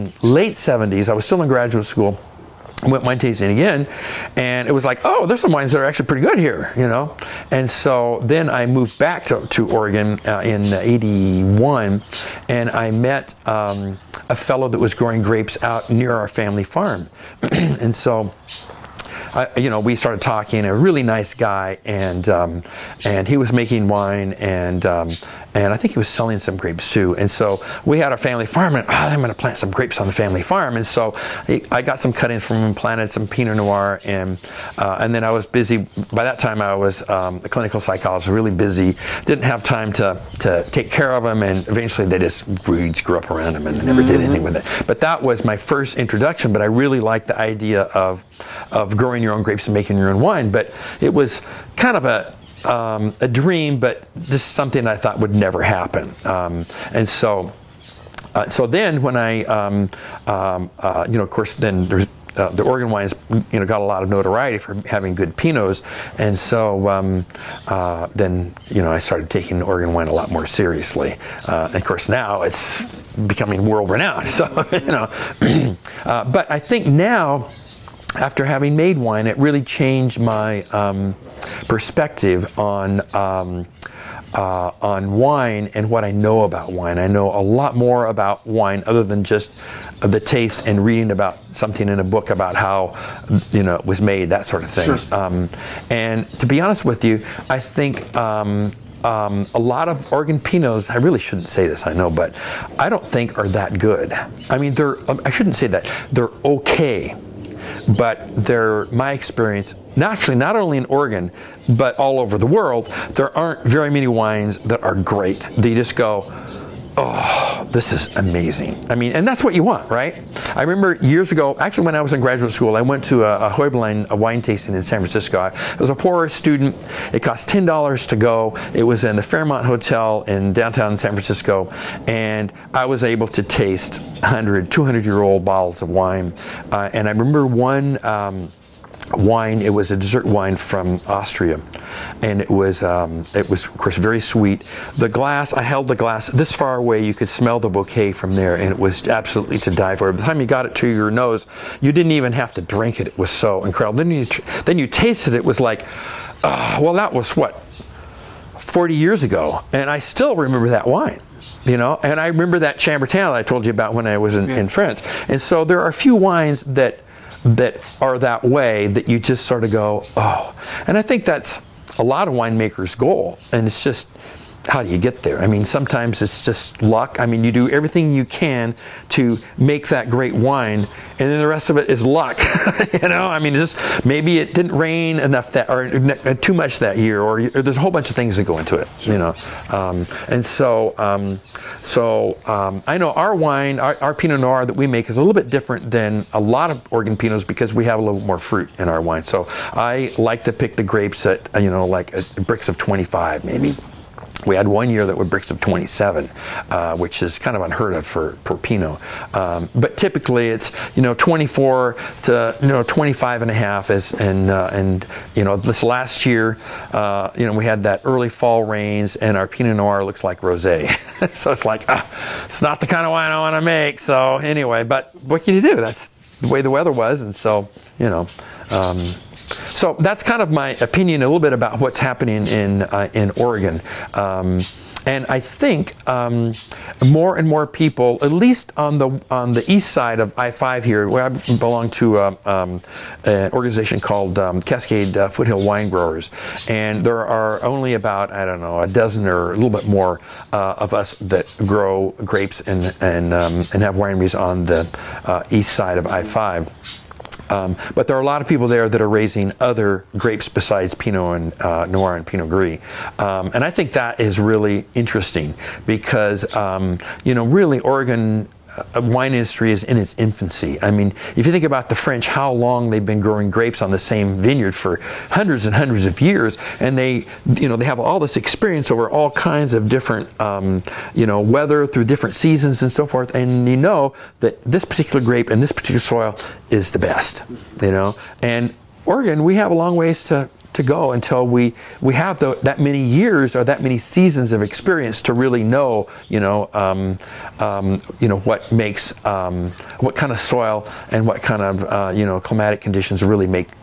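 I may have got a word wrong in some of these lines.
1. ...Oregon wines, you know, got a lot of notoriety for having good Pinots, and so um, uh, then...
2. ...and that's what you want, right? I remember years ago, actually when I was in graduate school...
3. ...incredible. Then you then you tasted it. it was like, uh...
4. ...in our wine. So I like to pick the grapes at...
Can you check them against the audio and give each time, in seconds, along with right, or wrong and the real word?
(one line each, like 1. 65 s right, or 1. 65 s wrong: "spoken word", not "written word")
1. 62 s right
2. 119 s right
3. 153 s right
4. 198 s right.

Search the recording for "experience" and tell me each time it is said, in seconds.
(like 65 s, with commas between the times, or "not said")
109 s, 278 s, 294 s.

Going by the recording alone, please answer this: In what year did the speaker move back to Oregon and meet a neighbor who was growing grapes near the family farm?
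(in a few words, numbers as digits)
1981.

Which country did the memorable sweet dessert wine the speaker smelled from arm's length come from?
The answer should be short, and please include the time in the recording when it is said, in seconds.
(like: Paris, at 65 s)
Austria, at 141 s.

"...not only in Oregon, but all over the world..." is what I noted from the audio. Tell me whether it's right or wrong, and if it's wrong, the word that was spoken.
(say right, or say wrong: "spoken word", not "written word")
right.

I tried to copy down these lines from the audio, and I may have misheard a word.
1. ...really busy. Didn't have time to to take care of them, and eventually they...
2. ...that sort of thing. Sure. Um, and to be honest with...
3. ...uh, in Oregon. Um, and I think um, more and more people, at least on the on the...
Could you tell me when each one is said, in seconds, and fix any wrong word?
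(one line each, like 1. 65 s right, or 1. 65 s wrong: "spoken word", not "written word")
1. 38 s right
2. 94 s right
3. 232 s right.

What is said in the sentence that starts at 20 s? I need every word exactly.
A really nice guy, and um, and he was making wine, and um, and I think he was selling some grapes too.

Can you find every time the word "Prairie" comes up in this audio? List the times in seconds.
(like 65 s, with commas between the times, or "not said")
not said.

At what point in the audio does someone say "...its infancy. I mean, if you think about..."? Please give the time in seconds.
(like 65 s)
269 s.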